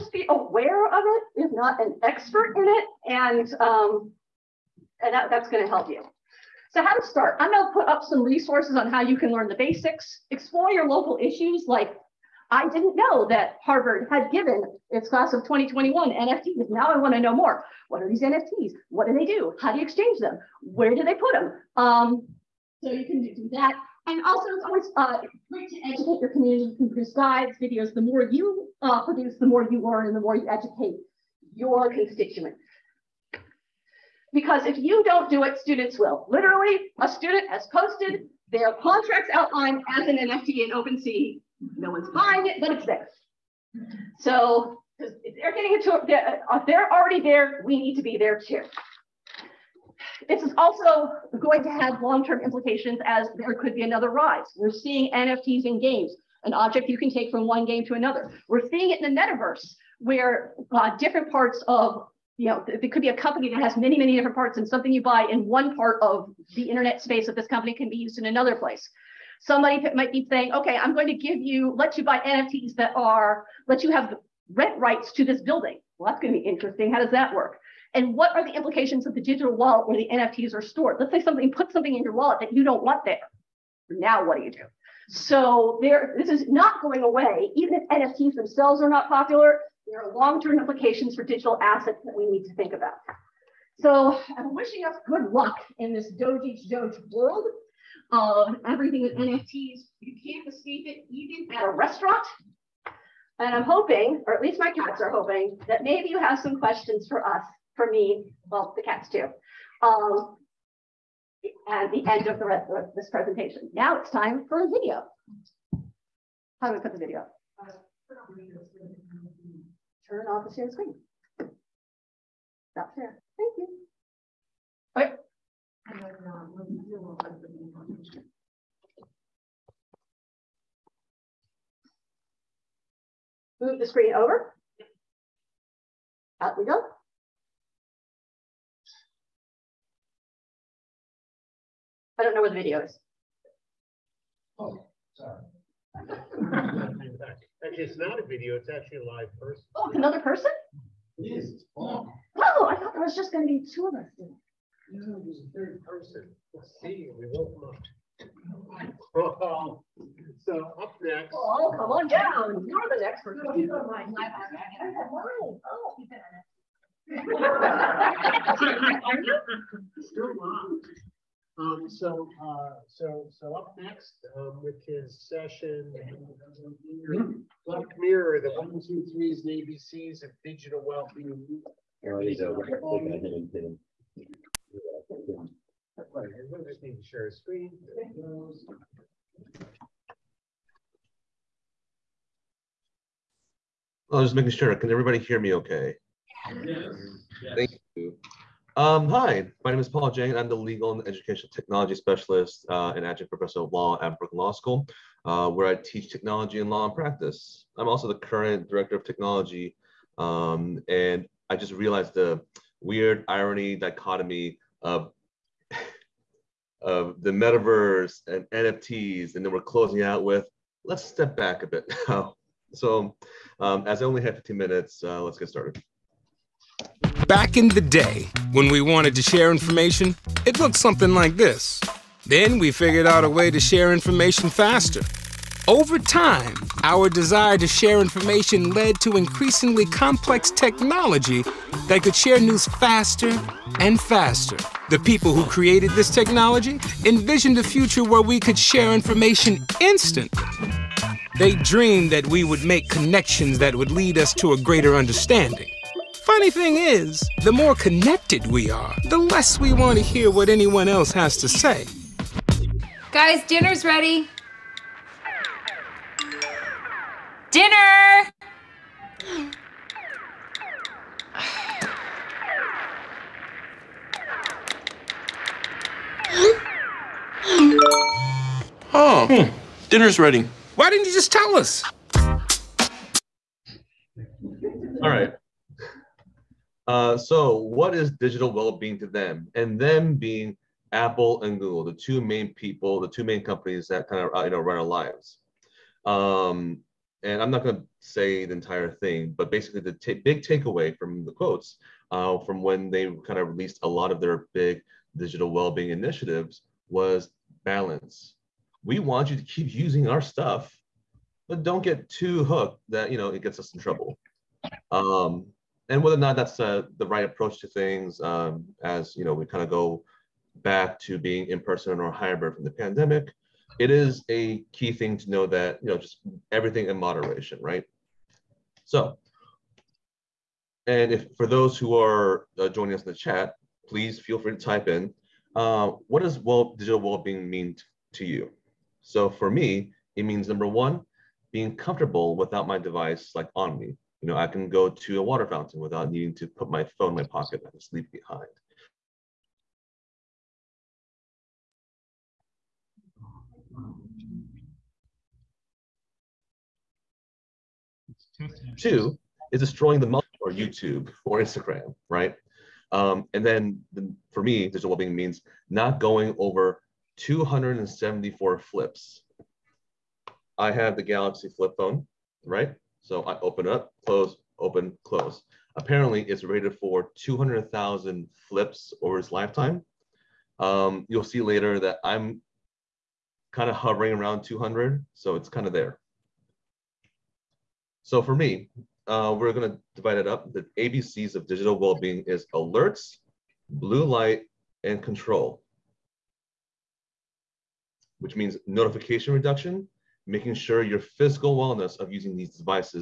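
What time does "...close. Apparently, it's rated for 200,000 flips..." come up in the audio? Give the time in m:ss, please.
6:15.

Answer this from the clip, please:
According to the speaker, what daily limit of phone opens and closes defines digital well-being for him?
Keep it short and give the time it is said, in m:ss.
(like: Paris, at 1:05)
274, at 6:07.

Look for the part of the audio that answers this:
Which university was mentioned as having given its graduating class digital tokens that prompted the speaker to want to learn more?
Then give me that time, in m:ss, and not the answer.
0:13.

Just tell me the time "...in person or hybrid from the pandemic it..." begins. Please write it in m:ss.
5:21.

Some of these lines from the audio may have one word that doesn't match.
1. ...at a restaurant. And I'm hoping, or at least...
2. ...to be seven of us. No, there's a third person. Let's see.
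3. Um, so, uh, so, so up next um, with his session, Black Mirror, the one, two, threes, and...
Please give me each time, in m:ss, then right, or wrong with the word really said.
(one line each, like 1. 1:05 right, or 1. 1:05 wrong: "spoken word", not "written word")
1. 1:41 right
2. 2:33 wrong: "two", not "seven"
3. 2:51 right.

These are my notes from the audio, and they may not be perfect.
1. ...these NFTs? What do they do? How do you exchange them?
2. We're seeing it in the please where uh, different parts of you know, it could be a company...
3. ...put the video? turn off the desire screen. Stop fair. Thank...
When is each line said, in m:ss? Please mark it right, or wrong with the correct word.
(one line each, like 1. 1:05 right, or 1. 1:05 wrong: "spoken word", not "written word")
1. 0:18 right
2. 0:58 wrong: "metaverse", not "please"
3. 1:56 wrong: "share", not "desire".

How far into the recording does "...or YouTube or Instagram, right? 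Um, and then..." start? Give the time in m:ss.
6:00.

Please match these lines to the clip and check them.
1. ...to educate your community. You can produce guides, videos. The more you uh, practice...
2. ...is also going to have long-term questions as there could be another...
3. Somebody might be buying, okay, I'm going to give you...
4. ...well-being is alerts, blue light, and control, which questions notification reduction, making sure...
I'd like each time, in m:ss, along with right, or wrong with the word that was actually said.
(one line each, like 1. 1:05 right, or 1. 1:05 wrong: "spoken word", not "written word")
1. 0:25 wrong: "produce", not "practice"
2. 0:50 wrong: "implications", not "questions"
3. 1:09 wrong: "saying", not "buying"
4. 6:31 wrong: "means", not "questions".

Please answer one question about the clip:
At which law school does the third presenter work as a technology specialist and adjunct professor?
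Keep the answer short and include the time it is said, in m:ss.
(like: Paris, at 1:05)
Brooklyn Law School, at 3:24.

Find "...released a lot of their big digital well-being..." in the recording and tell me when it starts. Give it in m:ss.
5:03.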